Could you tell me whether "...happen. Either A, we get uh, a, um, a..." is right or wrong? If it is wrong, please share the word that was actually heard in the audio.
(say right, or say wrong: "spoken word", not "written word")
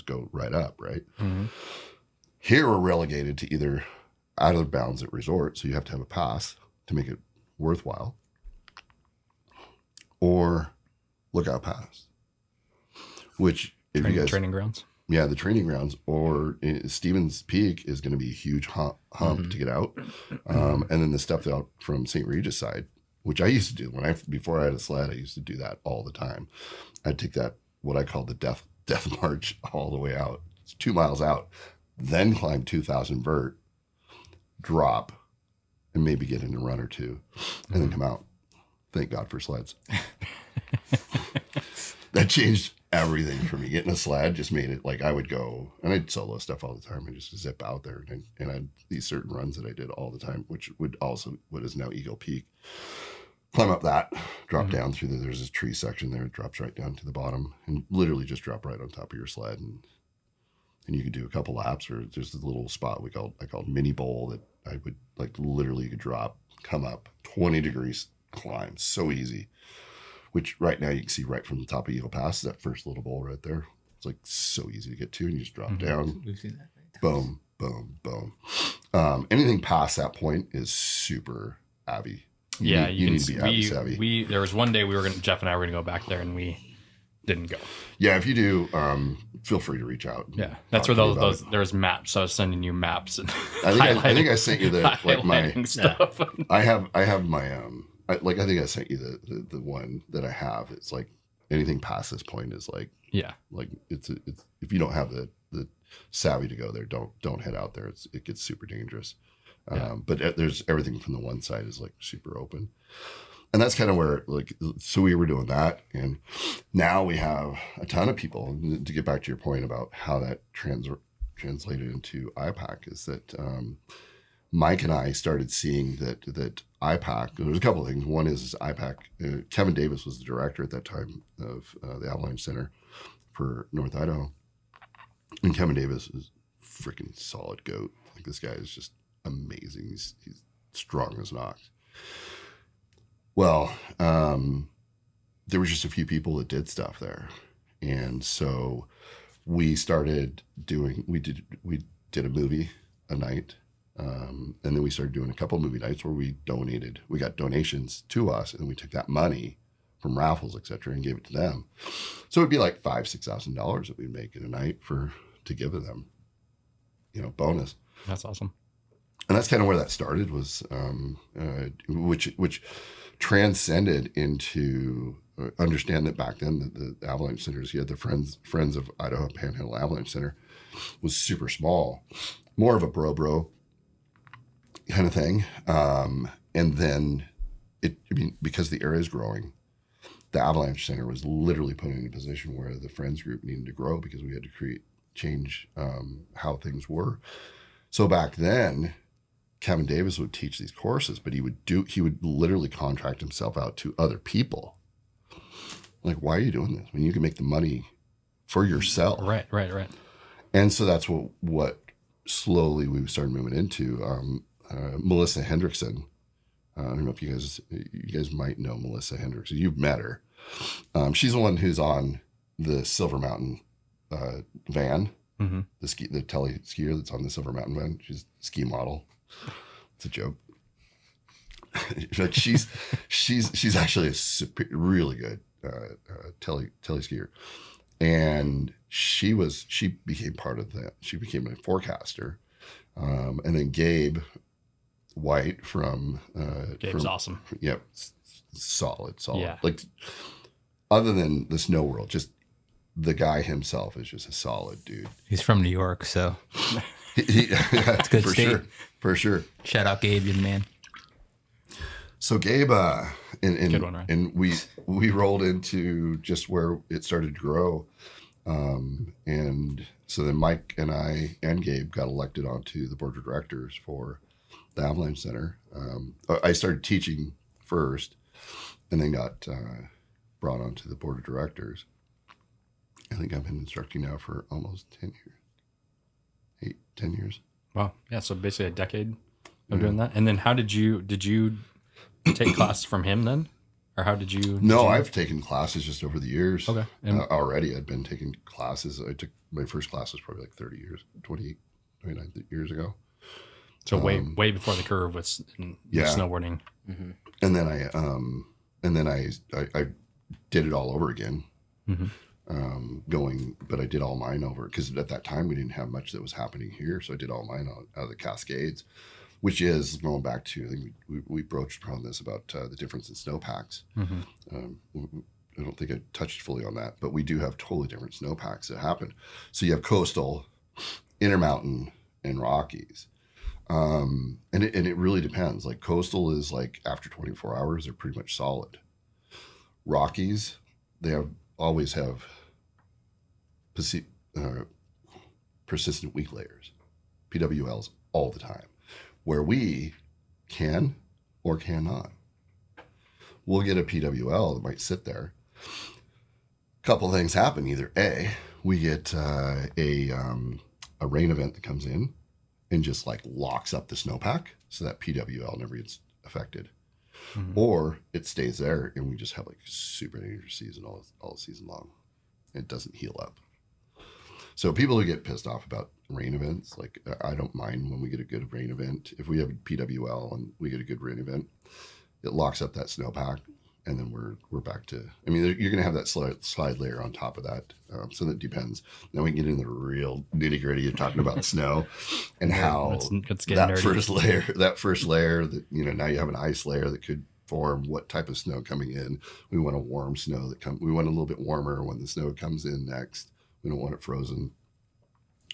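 right.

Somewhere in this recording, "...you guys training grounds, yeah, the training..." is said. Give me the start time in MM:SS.
00:14.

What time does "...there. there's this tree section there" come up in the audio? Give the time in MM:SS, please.
00:55.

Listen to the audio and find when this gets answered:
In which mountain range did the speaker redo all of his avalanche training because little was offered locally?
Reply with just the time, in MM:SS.
05:18.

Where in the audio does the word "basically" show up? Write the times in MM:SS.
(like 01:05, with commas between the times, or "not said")
04:48.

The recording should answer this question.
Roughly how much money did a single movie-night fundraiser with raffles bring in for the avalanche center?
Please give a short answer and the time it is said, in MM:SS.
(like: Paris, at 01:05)
5,000-6,000 dollars, at 02:42.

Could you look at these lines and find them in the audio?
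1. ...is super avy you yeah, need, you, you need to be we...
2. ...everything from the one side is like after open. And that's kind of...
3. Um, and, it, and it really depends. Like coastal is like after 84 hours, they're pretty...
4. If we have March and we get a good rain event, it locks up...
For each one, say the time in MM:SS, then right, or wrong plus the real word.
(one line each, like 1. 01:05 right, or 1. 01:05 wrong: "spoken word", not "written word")
1. 01:20 right
2. 01:50 wrong: "super", not "after"
3. 05:33 wrong: "24", not "84"
4. 06:19 wrong: "PWL", not "March".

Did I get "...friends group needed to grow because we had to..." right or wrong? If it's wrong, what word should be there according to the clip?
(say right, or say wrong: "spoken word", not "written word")
right.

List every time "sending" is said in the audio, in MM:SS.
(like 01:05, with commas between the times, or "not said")
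01:32.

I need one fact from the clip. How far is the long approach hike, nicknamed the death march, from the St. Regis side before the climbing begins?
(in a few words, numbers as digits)
2 miles.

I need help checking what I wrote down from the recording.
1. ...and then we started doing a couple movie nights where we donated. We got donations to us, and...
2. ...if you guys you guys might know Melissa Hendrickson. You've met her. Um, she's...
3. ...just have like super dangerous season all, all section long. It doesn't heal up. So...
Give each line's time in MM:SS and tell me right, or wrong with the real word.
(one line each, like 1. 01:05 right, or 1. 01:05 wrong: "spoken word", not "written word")
1. 02:34 right
2. 03:37 right
3. 06:09 wrong: "season", not "section".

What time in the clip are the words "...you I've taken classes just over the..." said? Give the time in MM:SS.
04:54.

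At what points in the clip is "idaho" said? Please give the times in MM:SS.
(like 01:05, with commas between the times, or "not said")
02:13, 02:58.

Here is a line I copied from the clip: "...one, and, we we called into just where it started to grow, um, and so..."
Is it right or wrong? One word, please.
wrong.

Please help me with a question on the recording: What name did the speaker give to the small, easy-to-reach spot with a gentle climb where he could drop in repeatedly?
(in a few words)
mini bowl.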